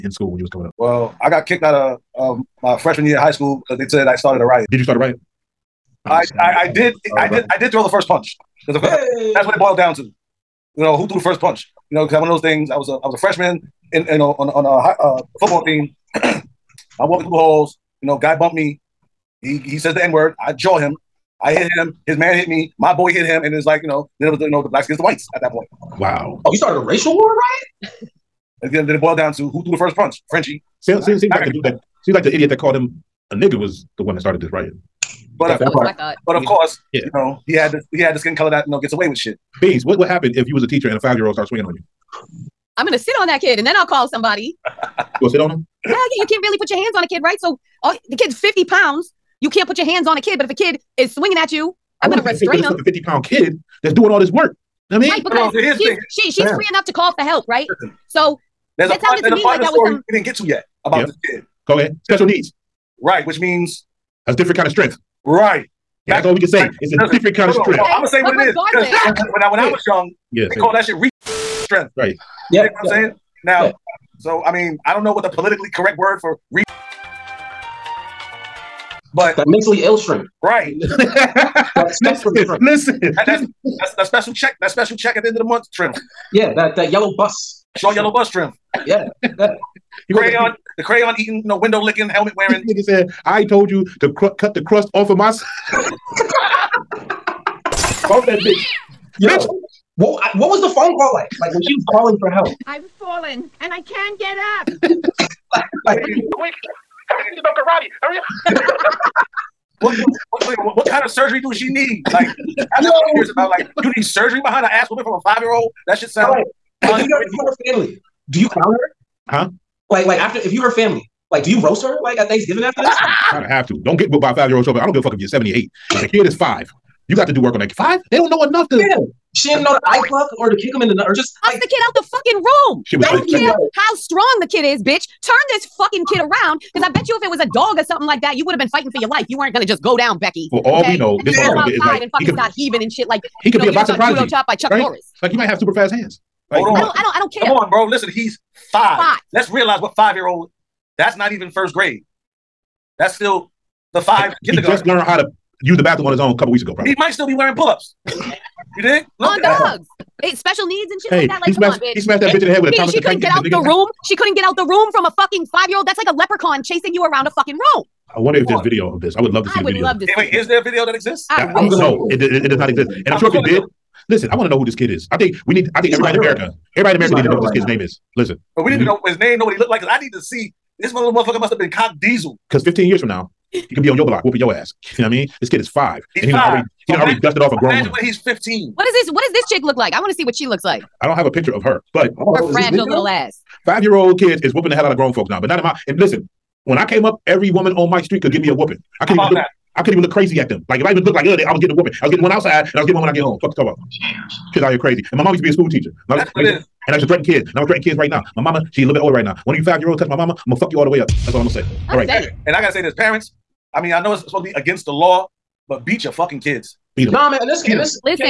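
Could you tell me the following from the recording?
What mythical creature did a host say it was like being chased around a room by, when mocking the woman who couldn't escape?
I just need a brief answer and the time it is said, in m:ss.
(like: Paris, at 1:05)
Leprechaun, at 2:46.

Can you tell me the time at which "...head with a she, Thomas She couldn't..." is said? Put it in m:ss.
2:42.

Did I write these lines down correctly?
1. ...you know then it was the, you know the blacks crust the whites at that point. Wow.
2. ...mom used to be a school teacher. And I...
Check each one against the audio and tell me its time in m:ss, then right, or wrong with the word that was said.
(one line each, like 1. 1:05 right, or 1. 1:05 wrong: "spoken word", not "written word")
1. 0:23 wrong: "against", not "crust"
2. 3:25 right.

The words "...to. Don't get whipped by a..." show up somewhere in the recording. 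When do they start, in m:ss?
2:03.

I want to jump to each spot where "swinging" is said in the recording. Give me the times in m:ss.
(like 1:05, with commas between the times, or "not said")
0:41, 0:51.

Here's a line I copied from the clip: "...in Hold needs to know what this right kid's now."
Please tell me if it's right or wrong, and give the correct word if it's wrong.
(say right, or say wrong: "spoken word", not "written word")
wrong: "America", not "Hold".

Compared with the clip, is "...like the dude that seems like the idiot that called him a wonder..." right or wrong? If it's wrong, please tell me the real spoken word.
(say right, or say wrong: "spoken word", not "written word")
wrong: "nigger", not "wonder".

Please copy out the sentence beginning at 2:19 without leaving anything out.
You weren't gonna just go down, Becky.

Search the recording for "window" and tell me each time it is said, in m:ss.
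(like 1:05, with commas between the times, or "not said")
1:31.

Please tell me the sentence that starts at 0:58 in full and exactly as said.
so there's that a part, sounded to me like that was some...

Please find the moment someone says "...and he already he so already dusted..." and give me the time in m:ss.
3:06.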